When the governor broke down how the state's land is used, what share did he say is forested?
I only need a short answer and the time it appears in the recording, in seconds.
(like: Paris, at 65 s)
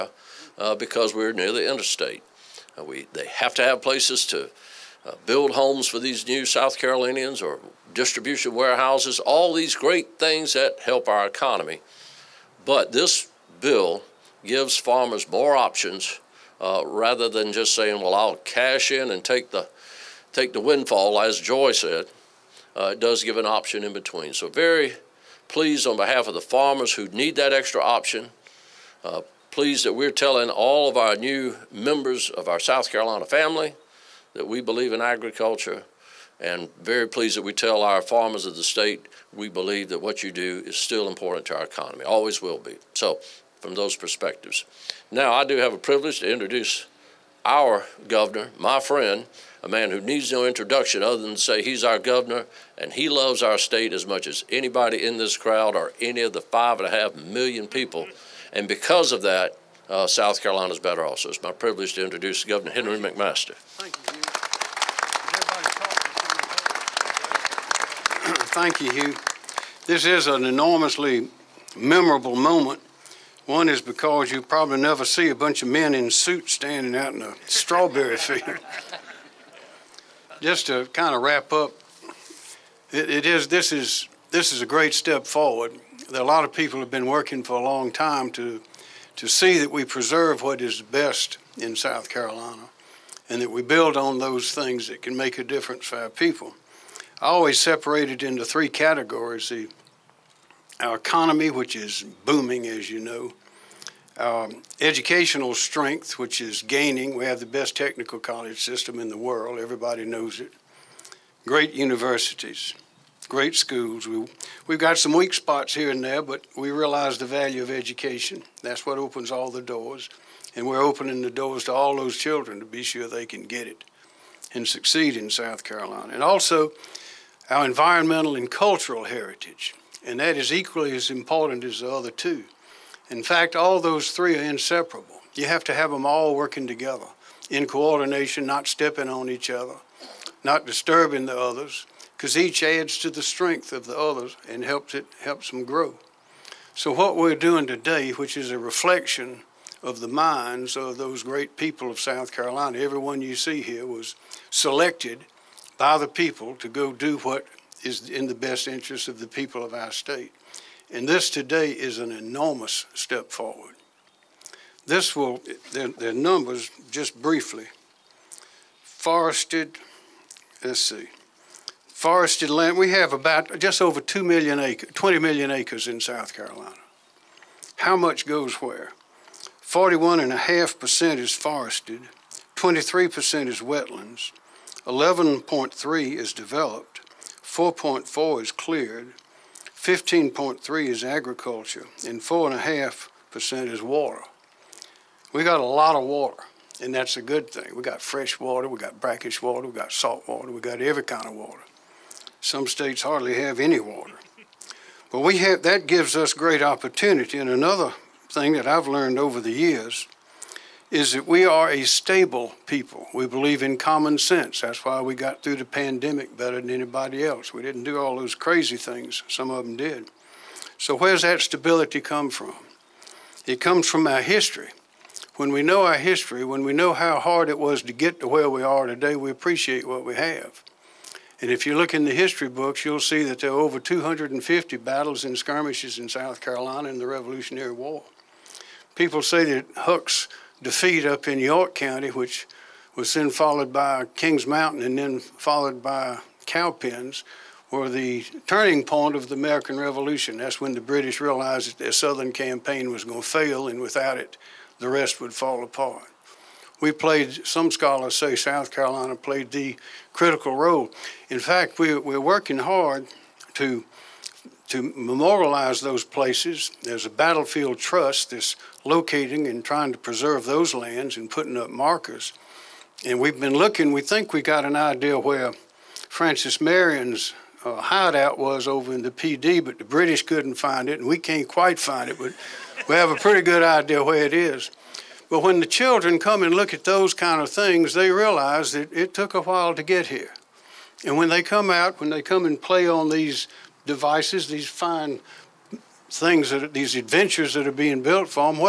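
41.5%, at 179 s.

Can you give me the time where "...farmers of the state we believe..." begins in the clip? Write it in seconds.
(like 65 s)
38 s.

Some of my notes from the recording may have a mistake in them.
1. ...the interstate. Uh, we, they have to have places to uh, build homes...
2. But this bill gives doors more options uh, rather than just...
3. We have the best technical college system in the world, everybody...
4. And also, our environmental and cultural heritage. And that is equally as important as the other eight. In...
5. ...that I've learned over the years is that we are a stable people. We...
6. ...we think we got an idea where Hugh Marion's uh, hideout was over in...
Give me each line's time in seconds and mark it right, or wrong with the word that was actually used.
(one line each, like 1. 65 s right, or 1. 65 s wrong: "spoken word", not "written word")
1. 1 s right
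2. 12 s wrong: "farmers", not "doors"
3. 107 s right
4. 126 s wrong: "two", not "eight"
5. 208 s right
6. 273 s wrong: "Francis", not "Hugh".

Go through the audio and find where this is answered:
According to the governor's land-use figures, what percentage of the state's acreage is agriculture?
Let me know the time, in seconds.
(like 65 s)
189 s.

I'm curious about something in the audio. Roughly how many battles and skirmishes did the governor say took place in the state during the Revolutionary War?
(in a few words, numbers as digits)
over 250.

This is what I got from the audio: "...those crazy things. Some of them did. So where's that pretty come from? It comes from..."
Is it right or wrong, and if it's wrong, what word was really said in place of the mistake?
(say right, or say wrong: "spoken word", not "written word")
wrong: "stability", not "pretty".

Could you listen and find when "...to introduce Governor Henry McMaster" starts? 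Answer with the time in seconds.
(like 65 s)
61 s.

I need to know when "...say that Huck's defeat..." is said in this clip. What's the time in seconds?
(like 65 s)
239 s.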